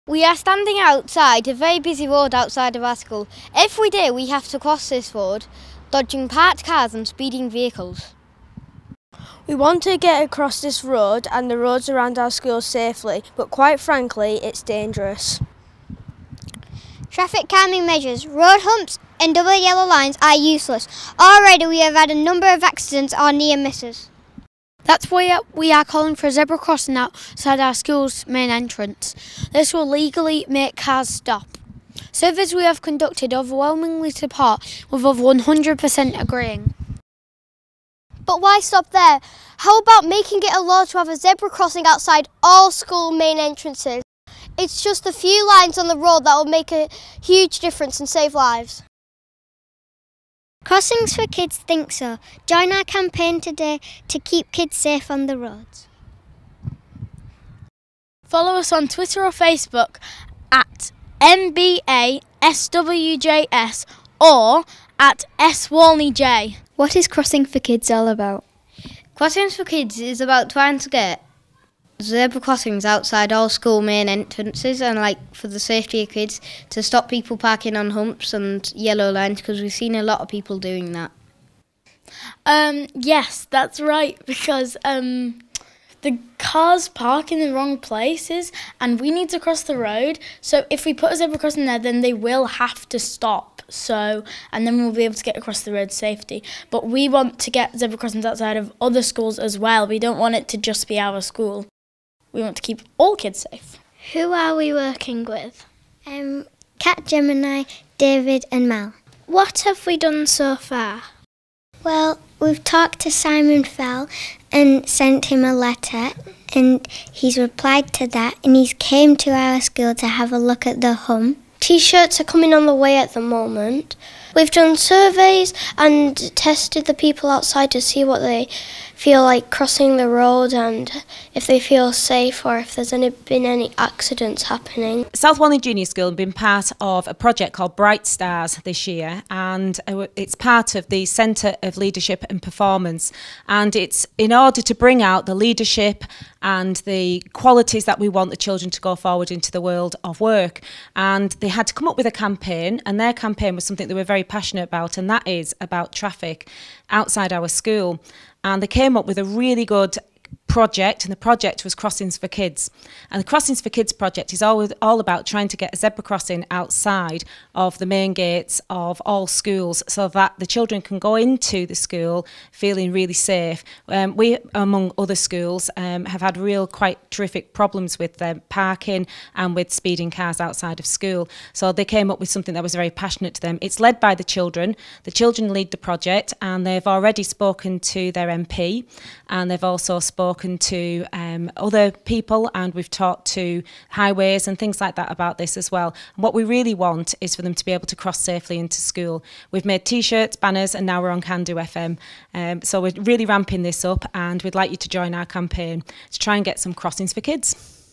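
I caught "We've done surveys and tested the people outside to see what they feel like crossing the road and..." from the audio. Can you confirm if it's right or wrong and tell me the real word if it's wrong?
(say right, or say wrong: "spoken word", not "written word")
right.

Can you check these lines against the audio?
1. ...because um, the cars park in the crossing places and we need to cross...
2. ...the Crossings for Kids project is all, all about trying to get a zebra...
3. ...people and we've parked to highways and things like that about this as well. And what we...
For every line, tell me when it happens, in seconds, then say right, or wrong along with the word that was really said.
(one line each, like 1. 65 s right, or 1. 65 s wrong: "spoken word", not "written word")
1. 84 s wrong: "wrong", not "crossing"
2. 163 s right
3. 191 s wrong: "talked", not "parked".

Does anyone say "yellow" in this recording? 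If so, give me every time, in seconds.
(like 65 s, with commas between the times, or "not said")
19 s, 78 s.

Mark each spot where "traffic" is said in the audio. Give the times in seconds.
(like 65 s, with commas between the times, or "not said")
17 s, 155 s.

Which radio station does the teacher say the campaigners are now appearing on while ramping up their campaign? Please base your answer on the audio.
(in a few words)
Can Do FM.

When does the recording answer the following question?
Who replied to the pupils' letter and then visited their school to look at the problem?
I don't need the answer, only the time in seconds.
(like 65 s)
113 s.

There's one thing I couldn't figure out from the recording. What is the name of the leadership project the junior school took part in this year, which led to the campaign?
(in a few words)
Bright Stars.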